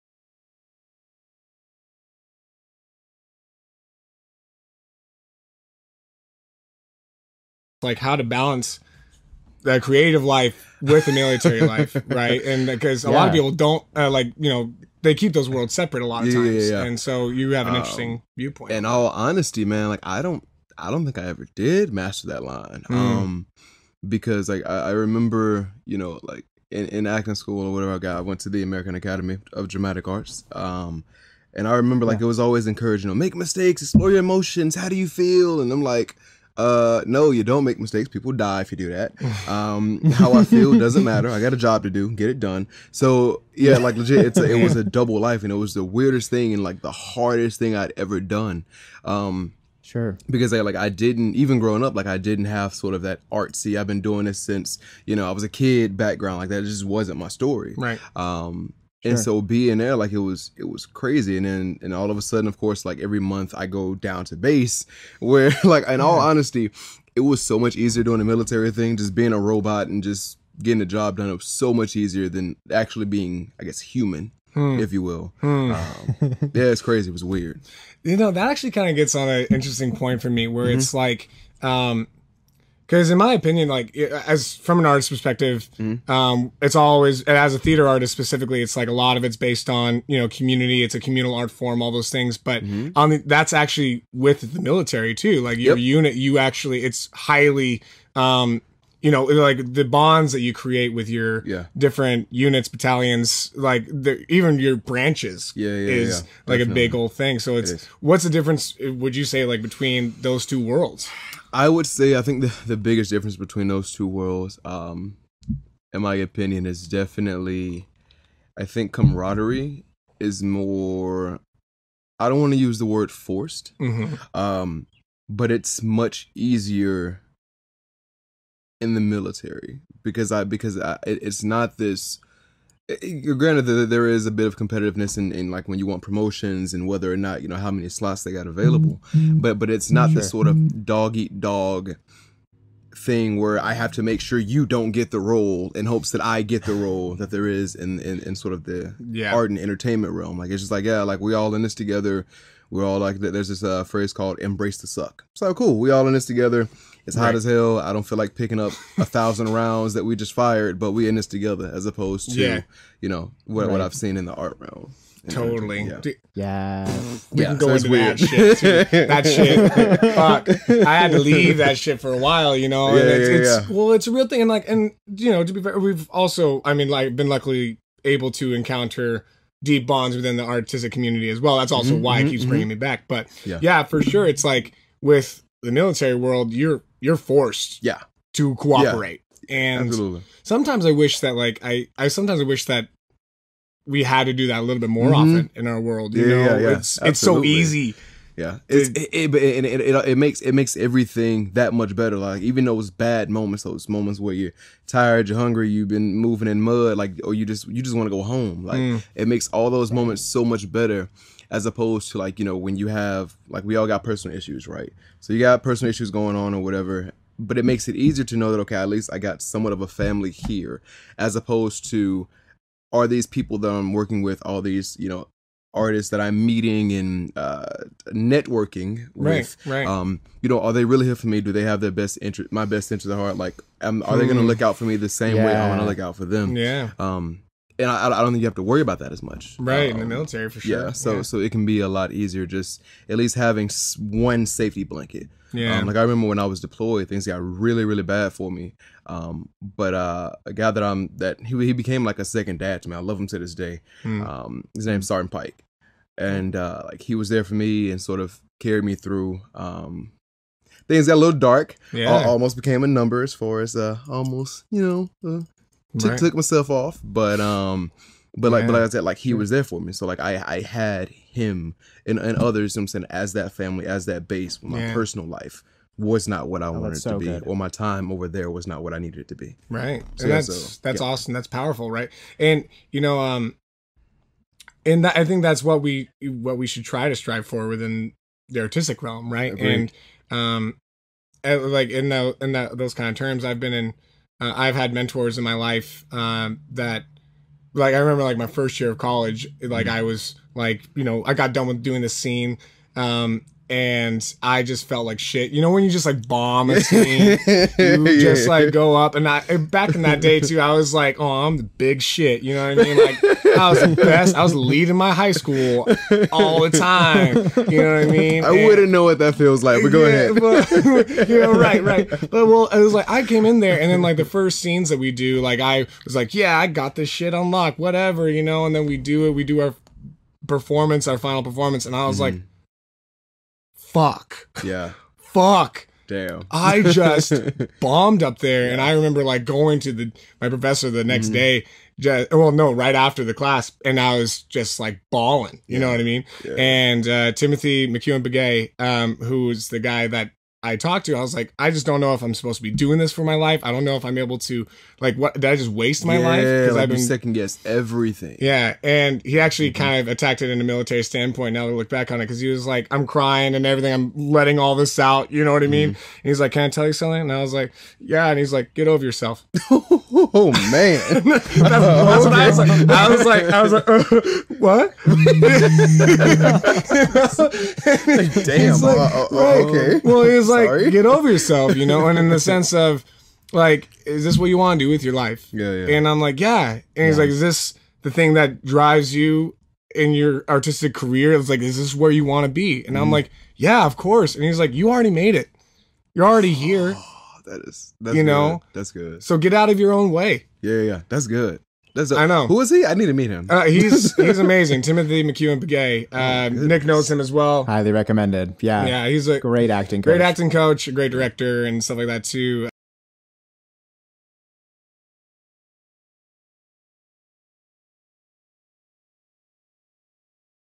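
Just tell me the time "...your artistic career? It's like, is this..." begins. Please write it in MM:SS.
06:30.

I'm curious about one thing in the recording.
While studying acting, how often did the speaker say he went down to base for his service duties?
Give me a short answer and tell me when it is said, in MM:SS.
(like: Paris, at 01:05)
Every month, at 01:02.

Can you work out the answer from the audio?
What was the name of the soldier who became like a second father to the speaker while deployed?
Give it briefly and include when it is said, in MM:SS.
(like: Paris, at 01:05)
Sergeant Pike, at 04:15.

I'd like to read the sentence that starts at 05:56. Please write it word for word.
Because like I've been second guess everything.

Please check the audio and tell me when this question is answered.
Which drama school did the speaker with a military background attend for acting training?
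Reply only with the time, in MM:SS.
00:28.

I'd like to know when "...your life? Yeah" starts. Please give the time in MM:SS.
06:25.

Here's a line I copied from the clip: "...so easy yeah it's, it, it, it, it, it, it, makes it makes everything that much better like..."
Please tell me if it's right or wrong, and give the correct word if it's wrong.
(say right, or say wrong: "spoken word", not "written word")
right.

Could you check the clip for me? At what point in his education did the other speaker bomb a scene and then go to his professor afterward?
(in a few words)
First year of college.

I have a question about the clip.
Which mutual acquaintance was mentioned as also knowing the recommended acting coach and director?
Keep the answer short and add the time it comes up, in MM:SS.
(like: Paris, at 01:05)
Nick, at 06:46.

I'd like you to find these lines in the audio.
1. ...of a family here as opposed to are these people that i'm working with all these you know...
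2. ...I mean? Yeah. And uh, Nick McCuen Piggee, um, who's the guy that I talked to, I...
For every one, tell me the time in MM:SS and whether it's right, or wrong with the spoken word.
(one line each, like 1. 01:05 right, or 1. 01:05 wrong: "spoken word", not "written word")
1. 03:39 right
2. 05:45 wrong: "Timothy", not "Nick".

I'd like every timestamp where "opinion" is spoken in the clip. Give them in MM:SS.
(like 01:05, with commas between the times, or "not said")
01:23, 01:56.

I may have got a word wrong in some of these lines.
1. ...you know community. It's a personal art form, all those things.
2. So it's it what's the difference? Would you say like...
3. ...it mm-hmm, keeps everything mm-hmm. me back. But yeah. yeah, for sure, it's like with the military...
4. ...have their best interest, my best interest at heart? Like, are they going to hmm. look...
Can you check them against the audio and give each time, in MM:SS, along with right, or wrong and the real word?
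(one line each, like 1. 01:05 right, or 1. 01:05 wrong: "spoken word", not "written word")
1. 01:30 wrong: "communal", not "personal"
2. 01:47 right
3. 03:02 wrong: "bringing", not "everything"
4. 03:51 right.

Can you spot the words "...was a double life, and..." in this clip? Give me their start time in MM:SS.
00:44.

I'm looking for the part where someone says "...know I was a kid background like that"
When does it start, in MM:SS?
00:55.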